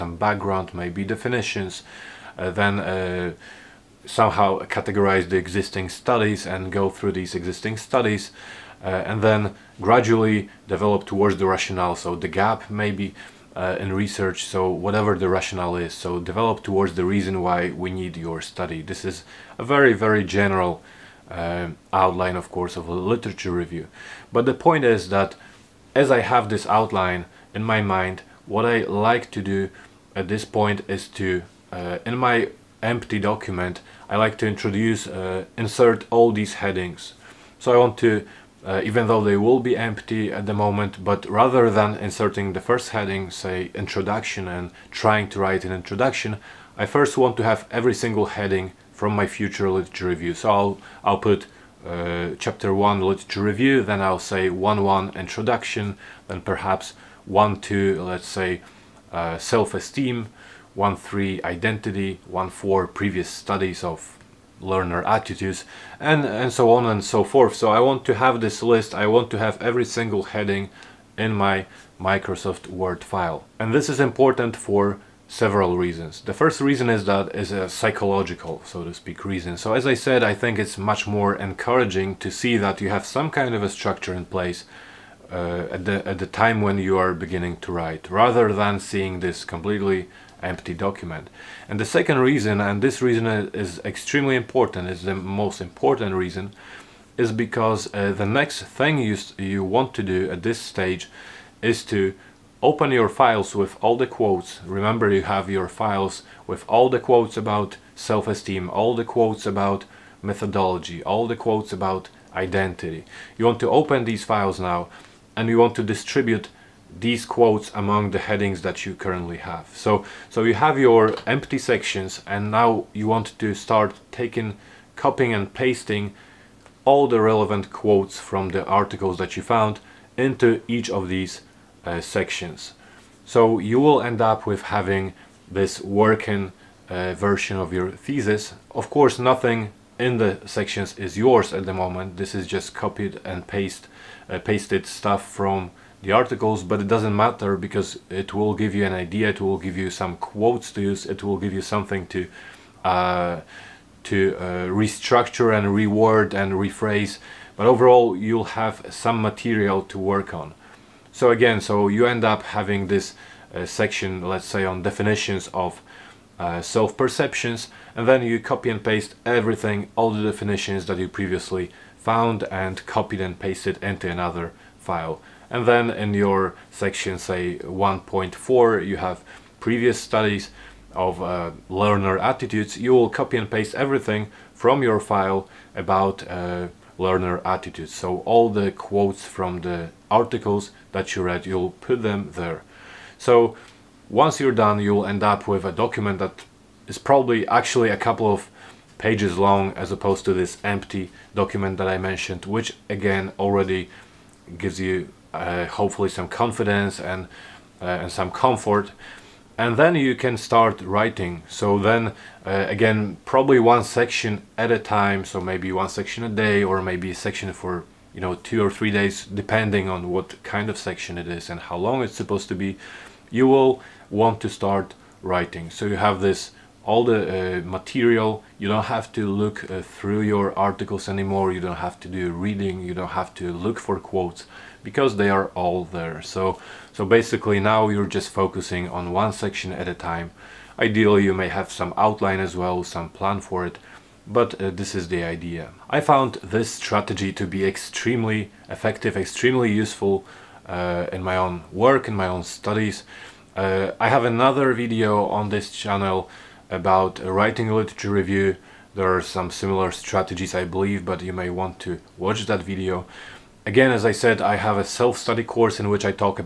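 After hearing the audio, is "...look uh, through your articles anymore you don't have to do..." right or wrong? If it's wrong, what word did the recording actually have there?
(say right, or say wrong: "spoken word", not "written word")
right.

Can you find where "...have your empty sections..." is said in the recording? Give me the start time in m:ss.
2:00.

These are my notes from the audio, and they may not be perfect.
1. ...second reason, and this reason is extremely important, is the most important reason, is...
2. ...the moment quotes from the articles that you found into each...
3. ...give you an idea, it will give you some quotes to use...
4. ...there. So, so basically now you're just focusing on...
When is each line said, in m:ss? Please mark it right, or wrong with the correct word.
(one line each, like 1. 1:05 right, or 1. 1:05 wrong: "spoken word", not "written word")
1. 1:31 right
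2. 2:07 wrong: "relevant", not "moment"
3. 2:28 right
4. 3:55 right.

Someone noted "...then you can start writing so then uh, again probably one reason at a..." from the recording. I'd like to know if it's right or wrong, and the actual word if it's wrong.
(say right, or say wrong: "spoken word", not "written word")
wrong: "section", not "reason".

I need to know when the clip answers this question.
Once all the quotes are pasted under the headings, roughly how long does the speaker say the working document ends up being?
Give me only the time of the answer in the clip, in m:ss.
3:17.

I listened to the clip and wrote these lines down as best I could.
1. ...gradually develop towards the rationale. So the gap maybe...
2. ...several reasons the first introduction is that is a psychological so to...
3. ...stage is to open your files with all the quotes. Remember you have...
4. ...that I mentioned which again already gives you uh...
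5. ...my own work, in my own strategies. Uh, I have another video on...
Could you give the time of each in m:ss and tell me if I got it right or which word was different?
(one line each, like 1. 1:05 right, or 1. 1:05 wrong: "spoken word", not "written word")
1. 0:09 right
2. 1:15 wrong: "reason", not "introduction"
3. 1:40 right
4. 3:21 right
5. 4:11 wrong: "studies", not "strategies".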